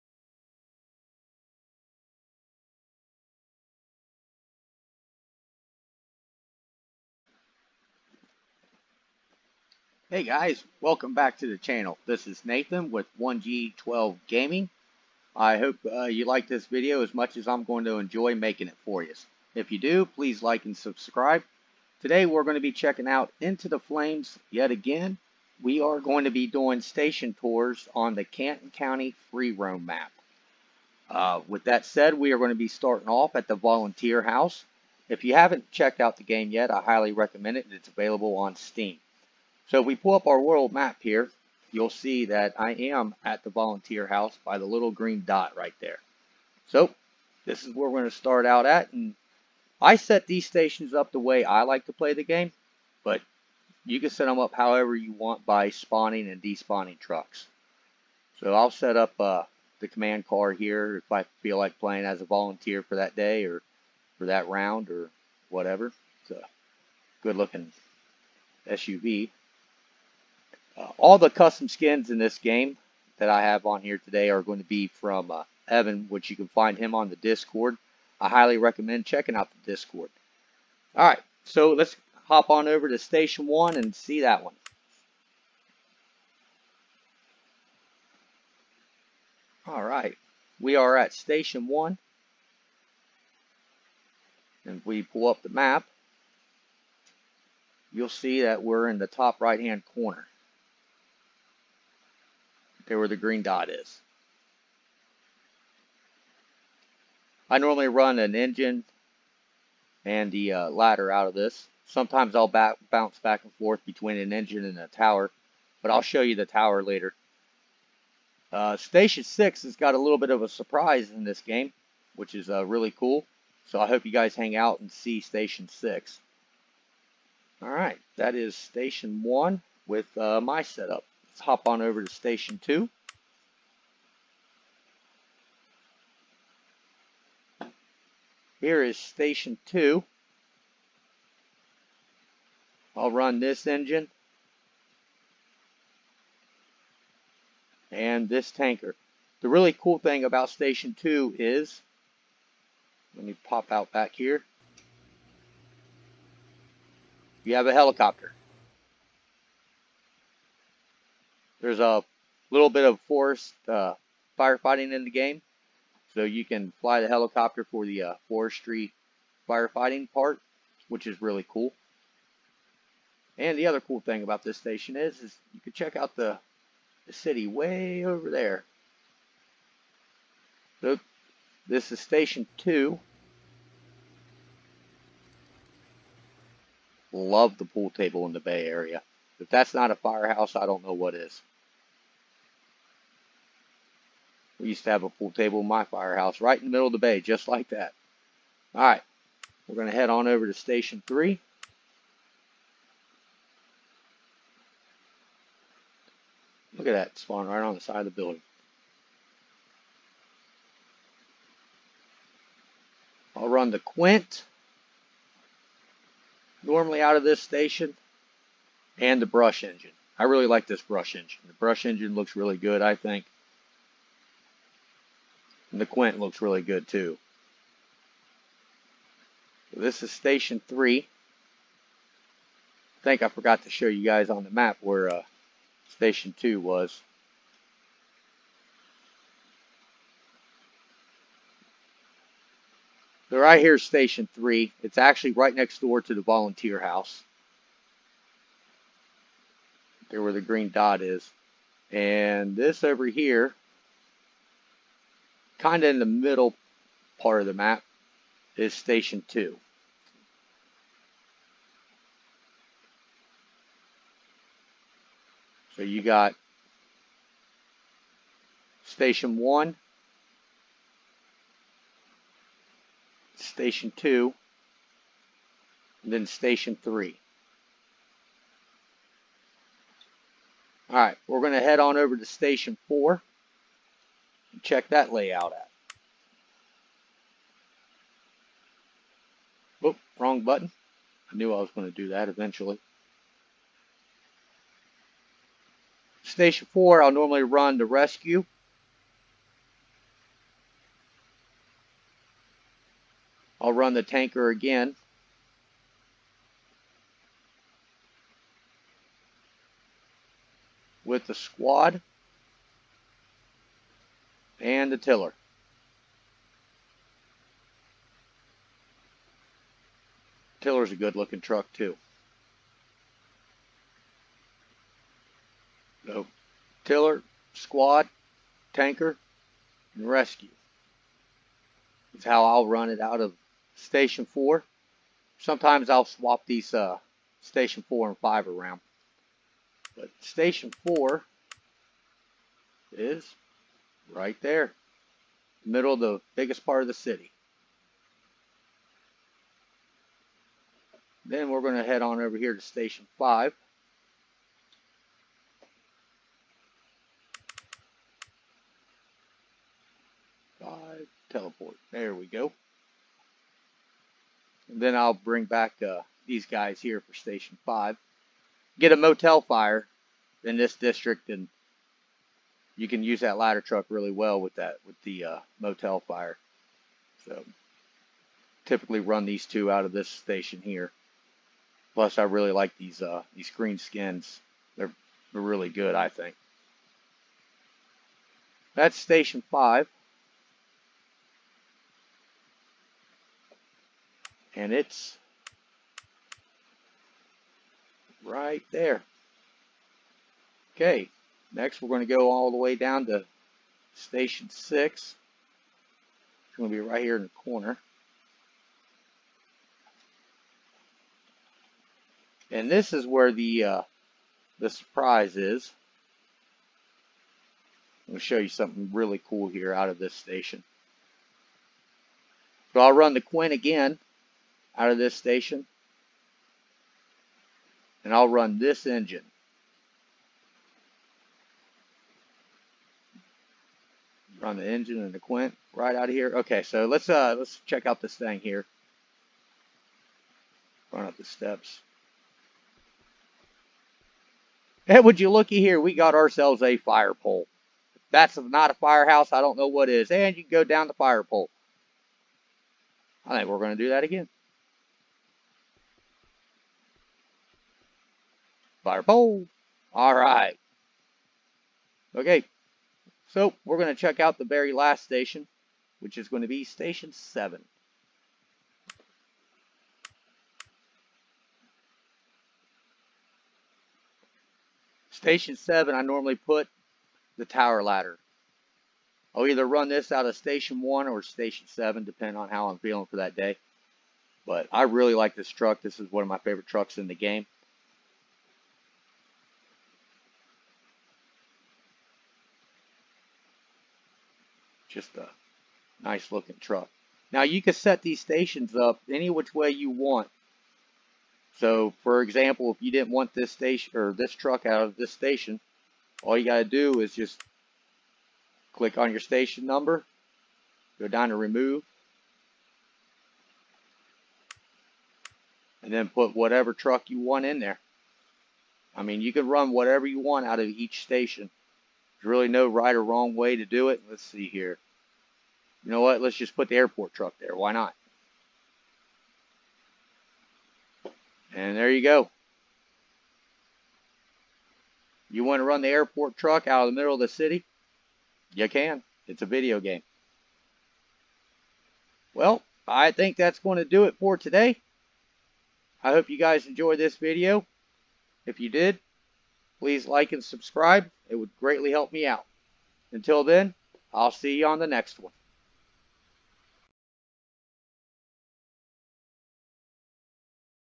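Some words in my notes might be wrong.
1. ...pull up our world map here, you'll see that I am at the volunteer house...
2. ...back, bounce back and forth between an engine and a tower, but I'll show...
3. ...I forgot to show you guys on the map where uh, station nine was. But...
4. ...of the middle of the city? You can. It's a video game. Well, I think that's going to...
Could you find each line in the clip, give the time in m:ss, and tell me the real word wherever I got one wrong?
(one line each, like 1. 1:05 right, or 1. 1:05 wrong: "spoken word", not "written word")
1. 0:39 right
2. 1:52 right
3. 3:53 wrong: "two", not "nine"
4. 8:56 right.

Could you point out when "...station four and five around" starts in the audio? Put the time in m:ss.
5:37.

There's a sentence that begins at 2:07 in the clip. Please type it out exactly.
Alright, that is Station 1 with uh, my setup.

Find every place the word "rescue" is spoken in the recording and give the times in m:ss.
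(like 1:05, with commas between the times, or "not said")
4:57, 5:30.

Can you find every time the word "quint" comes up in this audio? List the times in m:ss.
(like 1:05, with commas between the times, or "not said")
3:33, 3:45, 7:03, 7:15.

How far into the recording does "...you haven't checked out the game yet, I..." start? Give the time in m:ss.
0:35.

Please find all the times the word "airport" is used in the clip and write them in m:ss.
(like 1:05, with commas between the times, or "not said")
8:46, 8:55.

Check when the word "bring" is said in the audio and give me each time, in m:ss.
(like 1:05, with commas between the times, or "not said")
6:05.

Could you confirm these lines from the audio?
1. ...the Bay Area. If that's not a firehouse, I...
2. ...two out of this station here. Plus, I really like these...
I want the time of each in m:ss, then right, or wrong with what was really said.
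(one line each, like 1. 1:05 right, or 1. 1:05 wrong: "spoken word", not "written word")
1. 3:08 right
2. 6:19 right.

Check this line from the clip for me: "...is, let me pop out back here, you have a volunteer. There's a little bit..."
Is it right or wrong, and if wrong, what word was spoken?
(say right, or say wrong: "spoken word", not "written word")
wrong: "helicopter", not "volunteer".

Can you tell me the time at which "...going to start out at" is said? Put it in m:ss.
0:48.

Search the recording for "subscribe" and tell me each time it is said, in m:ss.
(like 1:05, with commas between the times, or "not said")
0:20, 9:10.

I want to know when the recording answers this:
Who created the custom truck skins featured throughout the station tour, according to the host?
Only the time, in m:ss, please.
1:15.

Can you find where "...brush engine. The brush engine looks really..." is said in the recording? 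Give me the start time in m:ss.
3:40.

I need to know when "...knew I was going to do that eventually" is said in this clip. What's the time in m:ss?
4:51.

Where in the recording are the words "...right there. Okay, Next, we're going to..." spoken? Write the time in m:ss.
6:38.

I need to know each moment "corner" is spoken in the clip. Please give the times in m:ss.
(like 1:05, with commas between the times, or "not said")
1:39, 6:47.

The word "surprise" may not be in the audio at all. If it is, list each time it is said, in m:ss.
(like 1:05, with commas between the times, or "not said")
2:00, 6:54.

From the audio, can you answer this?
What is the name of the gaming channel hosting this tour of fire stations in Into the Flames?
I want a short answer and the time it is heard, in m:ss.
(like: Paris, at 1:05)
1G12 Gaming, at 0:13.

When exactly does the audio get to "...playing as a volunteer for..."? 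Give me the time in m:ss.
1:01.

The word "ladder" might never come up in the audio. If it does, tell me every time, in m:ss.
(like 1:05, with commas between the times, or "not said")
1:50, 6:13, 7:57.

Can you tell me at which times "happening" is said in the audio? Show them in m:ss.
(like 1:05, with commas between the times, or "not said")
not said.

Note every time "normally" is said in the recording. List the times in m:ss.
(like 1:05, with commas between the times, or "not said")
1:47, 3:36, 4:57, 7:56.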